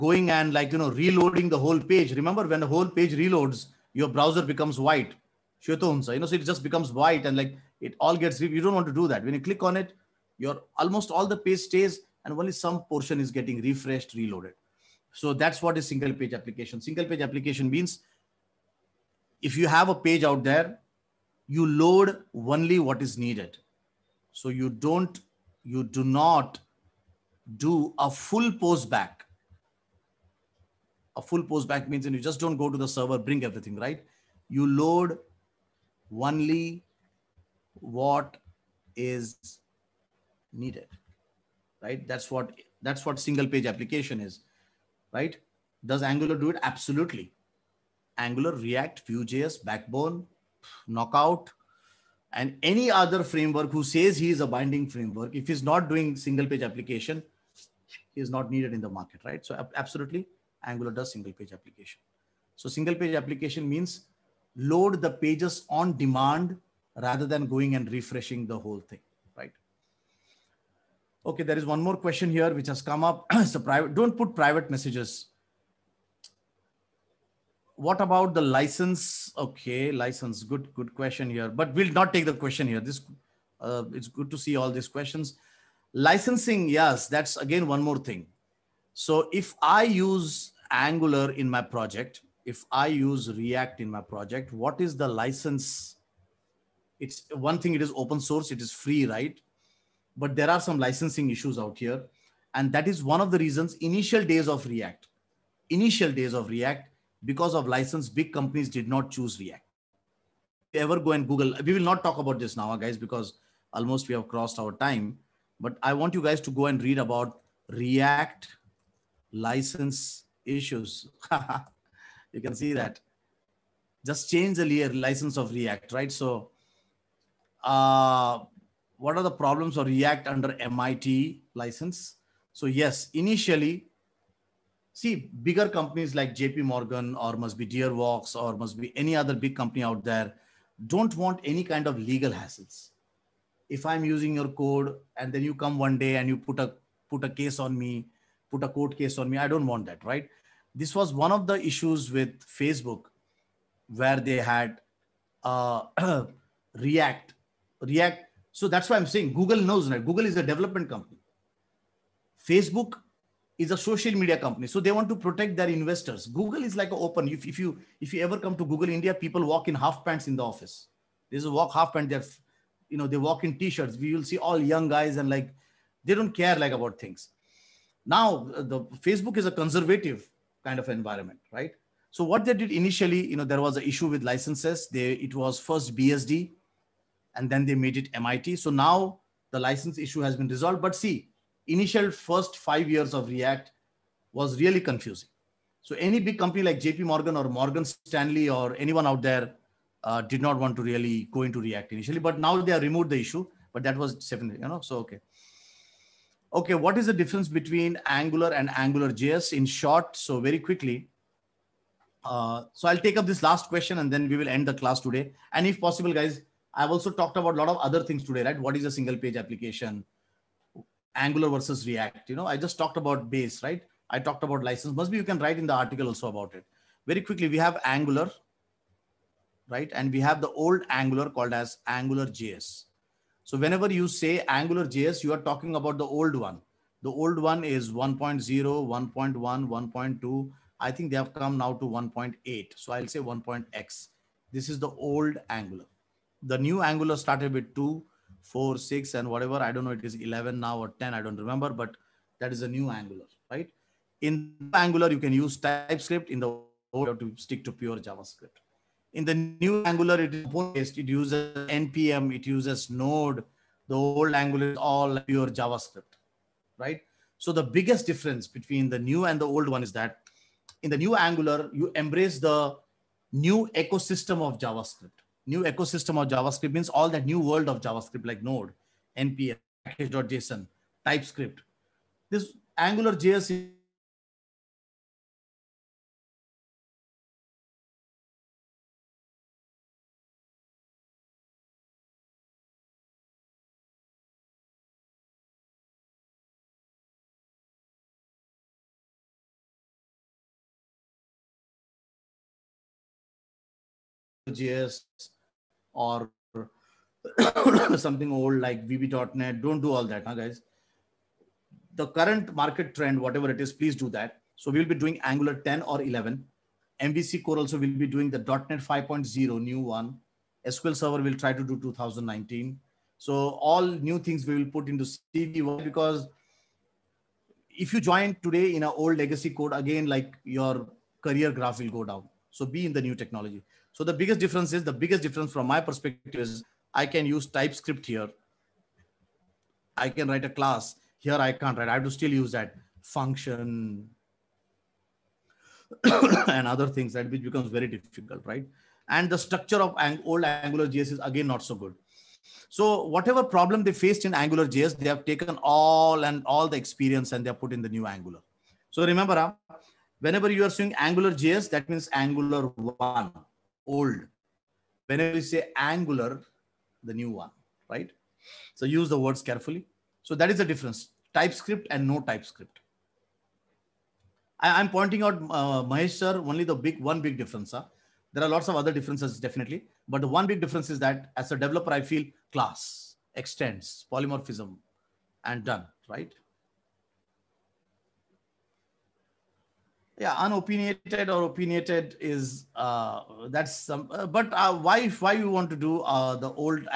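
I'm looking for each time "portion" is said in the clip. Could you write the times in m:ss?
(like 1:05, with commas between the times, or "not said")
0:12.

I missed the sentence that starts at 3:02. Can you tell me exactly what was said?
So what they did initially, you know, there was an issue with licenses.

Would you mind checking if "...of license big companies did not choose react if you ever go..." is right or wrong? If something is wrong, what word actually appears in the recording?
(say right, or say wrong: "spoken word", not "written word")
right.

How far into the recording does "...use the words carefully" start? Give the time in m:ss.
6:08.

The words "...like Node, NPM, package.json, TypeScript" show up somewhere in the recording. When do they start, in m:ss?
4:38.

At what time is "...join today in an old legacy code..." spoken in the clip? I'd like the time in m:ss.
5:27.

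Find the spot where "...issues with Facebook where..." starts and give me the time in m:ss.
2:31.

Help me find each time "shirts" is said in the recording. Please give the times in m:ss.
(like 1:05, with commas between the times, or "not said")
2:53.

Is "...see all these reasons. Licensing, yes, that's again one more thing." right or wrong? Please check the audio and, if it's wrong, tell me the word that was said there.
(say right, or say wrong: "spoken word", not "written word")
wrong: "questions", not "reasons".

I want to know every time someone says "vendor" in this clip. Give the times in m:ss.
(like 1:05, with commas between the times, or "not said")
not said.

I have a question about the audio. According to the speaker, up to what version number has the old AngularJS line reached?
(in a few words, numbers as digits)
1.8.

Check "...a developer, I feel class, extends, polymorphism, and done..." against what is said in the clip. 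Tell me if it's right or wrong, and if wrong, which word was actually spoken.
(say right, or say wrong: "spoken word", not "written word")
right.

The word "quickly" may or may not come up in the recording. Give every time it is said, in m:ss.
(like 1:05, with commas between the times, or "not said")
3:30, 3:47.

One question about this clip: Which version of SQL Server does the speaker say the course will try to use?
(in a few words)
2019.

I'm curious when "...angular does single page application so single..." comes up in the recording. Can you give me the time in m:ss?
1:00.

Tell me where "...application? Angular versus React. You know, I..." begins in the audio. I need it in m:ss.
3:39.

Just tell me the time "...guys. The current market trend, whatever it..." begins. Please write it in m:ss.
5:10.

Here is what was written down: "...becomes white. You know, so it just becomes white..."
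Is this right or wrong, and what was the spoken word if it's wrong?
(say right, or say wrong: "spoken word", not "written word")
right.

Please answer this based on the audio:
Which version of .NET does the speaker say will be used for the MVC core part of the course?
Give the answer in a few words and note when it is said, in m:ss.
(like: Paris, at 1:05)
.NET 5.0, at 5:18.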